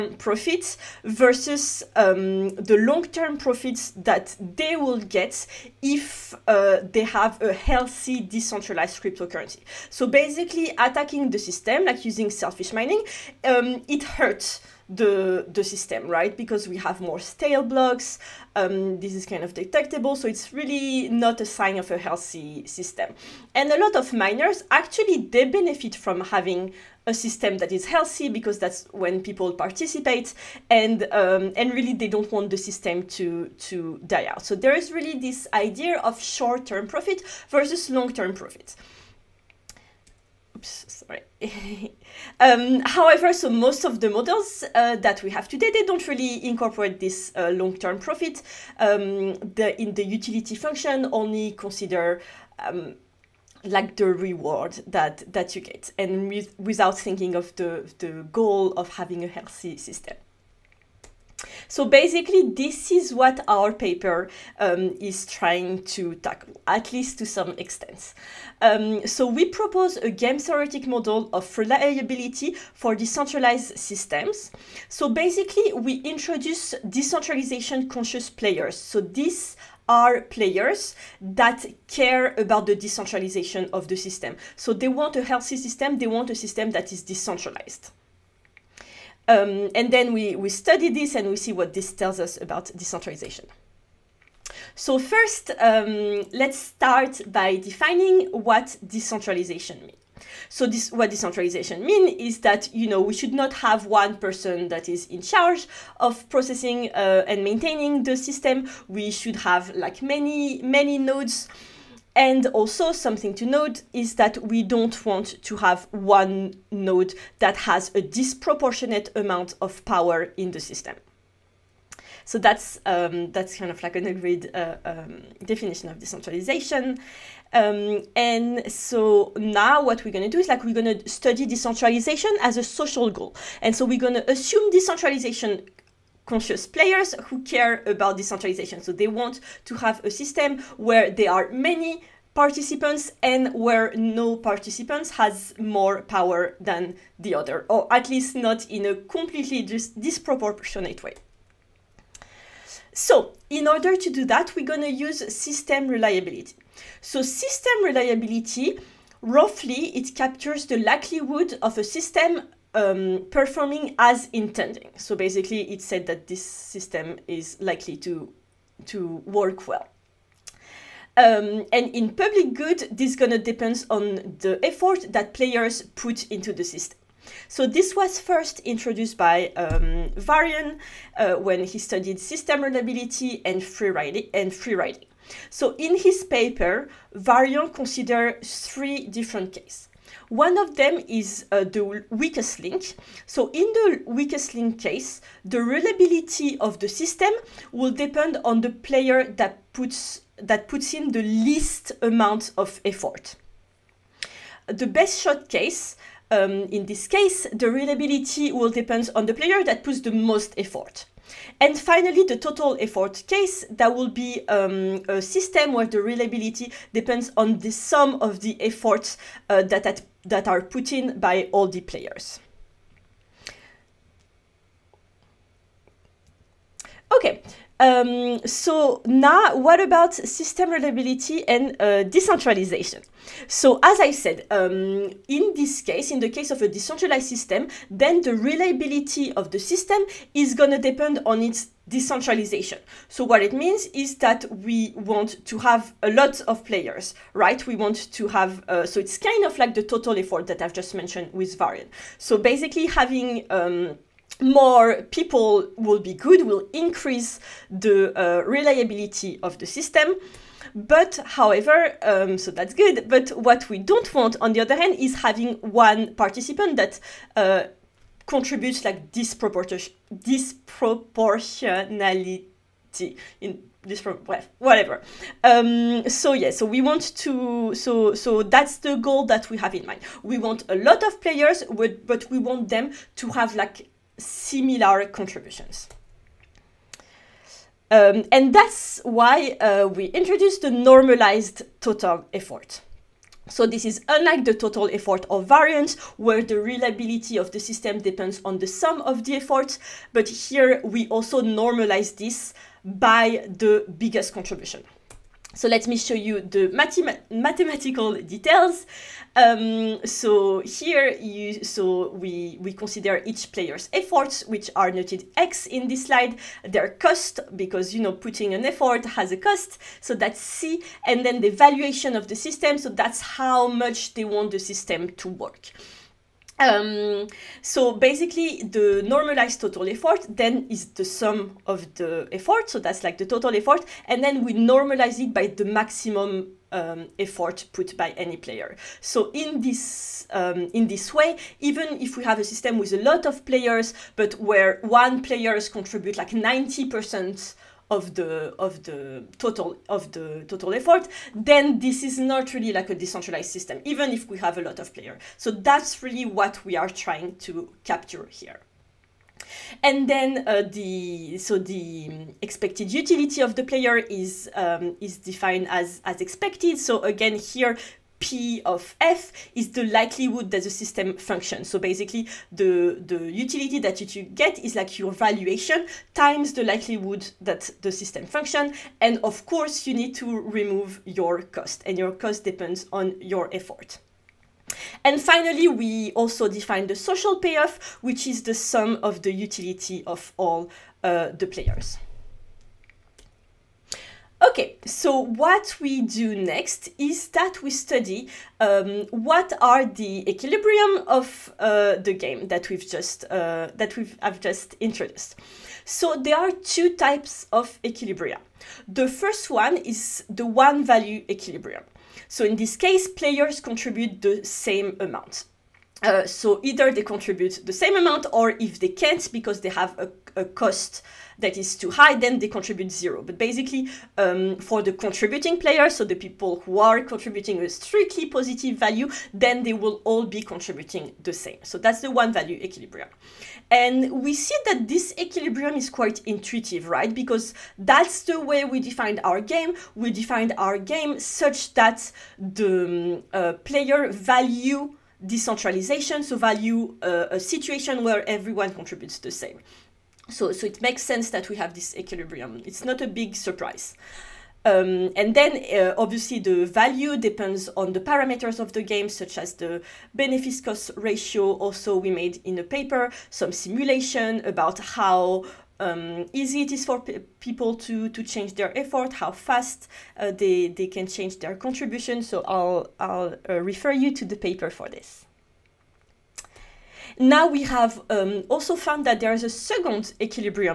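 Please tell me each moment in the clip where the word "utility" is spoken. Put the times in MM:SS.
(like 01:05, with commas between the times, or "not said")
00:50, 06:02, 06:13, 06:29.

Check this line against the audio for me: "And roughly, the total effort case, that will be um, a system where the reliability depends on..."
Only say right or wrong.
wrong.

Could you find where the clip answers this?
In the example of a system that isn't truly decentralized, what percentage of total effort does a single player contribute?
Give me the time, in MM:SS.
05:46.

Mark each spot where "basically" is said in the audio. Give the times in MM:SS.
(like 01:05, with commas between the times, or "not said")
00:10, 01:01, 01:15, 02:45, 04:12, 05:27, 06:11, 07:03.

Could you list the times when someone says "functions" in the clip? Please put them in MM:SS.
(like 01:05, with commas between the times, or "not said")
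00:50, 06:11, 06:18.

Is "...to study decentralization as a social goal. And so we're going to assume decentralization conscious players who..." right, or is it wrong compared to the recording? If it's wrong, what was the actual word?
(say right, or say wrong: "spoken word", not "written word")
right.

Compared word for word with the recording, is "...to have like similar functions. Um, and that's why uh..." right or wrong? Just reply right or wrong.
wrong.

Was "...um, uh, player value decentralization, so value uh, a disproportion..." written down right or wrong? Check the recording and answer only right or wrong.
wrong.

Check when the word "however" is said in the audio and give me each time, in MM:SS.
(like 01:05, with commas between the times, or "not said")
00:42, 04:21.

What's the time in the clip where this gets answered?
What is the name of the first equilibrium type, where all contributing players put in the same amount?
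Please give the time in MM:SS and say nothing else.
06:50.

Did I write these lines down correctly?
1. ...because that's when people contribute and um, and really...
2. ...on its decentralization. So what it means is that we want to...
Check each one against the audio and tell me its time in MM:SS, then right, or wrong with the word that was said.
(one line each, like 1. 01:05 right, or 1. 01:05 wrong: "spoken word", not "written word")
1. 00:28 wrong: "participate", not "contribute"
2. 04:01 right.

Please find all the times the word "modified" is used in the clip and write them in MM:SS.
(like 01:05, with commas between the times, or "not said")
not said.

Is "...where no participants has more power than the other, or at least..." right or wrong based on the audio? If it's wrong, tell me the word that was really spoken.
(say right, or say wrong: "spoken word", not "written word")
right.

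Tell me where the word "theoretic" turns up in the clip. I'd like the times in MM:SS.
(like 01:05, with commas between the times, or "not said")
01:10.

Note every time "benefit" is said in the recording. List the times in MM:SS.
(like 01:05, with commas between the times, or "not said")
00:25, 07:40.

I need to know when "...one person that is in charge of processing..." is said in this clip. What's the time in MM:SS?
01:43.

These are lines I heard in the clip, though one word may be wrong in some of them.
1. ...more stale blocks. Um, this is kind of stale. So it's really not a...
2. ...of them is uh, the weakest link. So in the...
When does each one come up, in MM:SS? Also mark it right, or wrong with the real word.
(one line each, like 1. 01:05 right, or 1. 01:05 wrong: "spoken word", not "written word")
1. 00:16 wrong: "detectable", not "stale"
2. 03:10 right.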